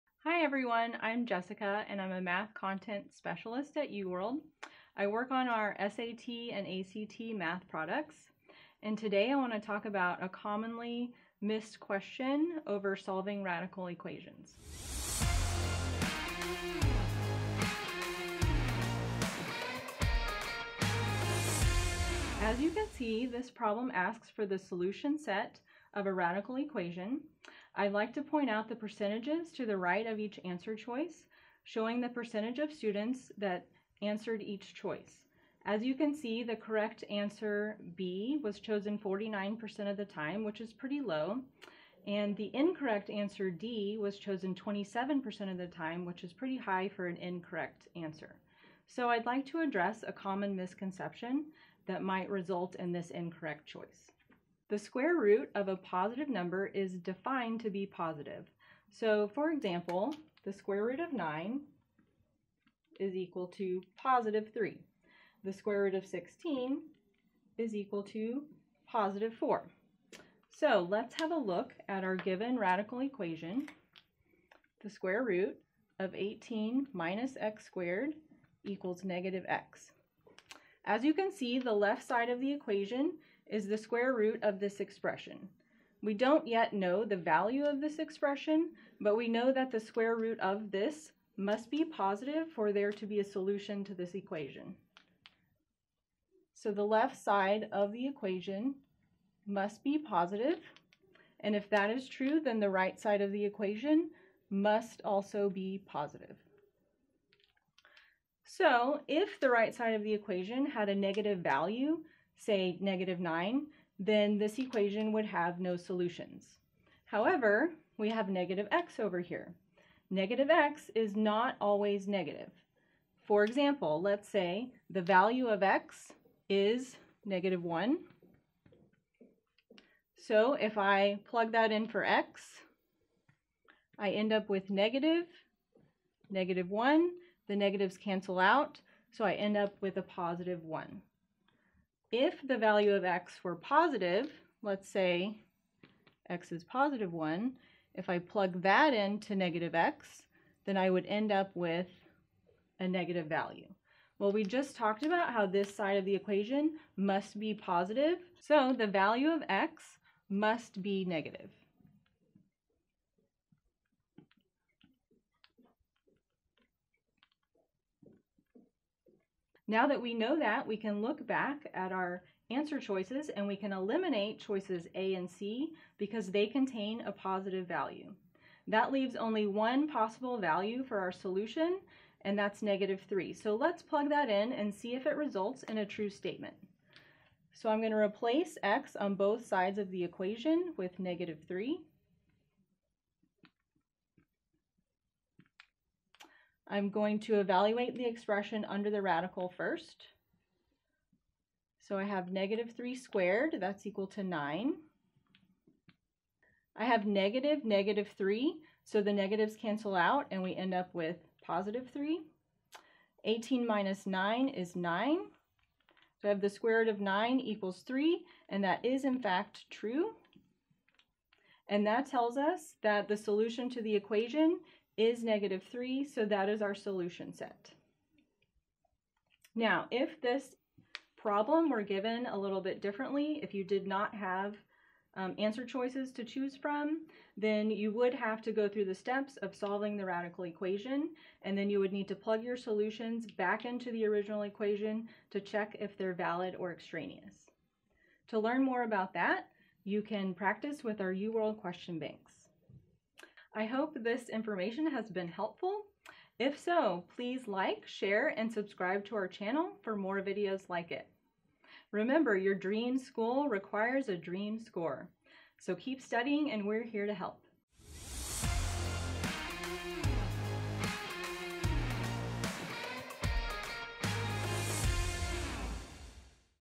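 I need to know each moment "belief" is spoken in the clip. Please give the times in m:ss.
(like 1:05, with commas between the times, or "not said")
not said.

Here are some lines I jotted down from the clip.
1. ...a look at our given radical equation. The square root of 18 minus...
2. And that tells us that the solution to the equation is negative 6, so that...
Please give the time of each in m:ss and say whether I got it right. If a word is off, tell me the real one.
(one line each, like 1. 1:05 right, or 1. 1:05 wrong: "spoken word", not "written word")
1. 1:11 right
2. 3:41 wrong: "3", not "6".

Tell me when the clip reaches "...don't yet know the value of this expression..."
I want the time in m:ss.
1:26.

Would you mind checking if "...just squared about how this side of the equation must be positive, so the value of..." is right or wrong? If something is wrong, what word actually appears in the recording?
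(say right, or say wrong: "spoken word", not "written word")
wrong: "talked", not "squared".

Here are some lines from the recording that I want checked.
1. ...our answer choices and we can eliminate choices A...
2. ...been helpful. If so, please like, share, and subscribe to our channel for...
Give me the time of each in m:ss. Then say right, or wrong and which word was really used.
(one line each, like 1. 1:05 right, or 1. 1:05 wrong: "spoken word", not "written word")
1. 2:51 right
2. 4:15 right.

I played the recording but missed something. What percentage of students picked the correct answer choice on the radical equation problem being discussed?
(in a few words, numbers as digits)
49%.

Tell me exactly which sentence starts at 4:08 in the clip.
To learn more about that, you can practice with our UWorld question banks.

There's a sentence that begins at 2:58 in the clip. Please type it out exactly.
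That leaves only one possible value for our solution, and that's negative 3.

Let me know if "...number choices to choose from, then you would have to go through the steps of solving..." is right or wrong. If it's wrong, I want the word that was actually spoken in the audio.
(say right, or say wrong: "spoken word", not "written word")
wrong: "answer", not "number".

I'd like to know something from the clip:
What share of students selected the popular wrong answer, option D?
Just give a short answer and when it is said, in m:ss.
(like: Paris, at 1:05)
27%, at 0:44.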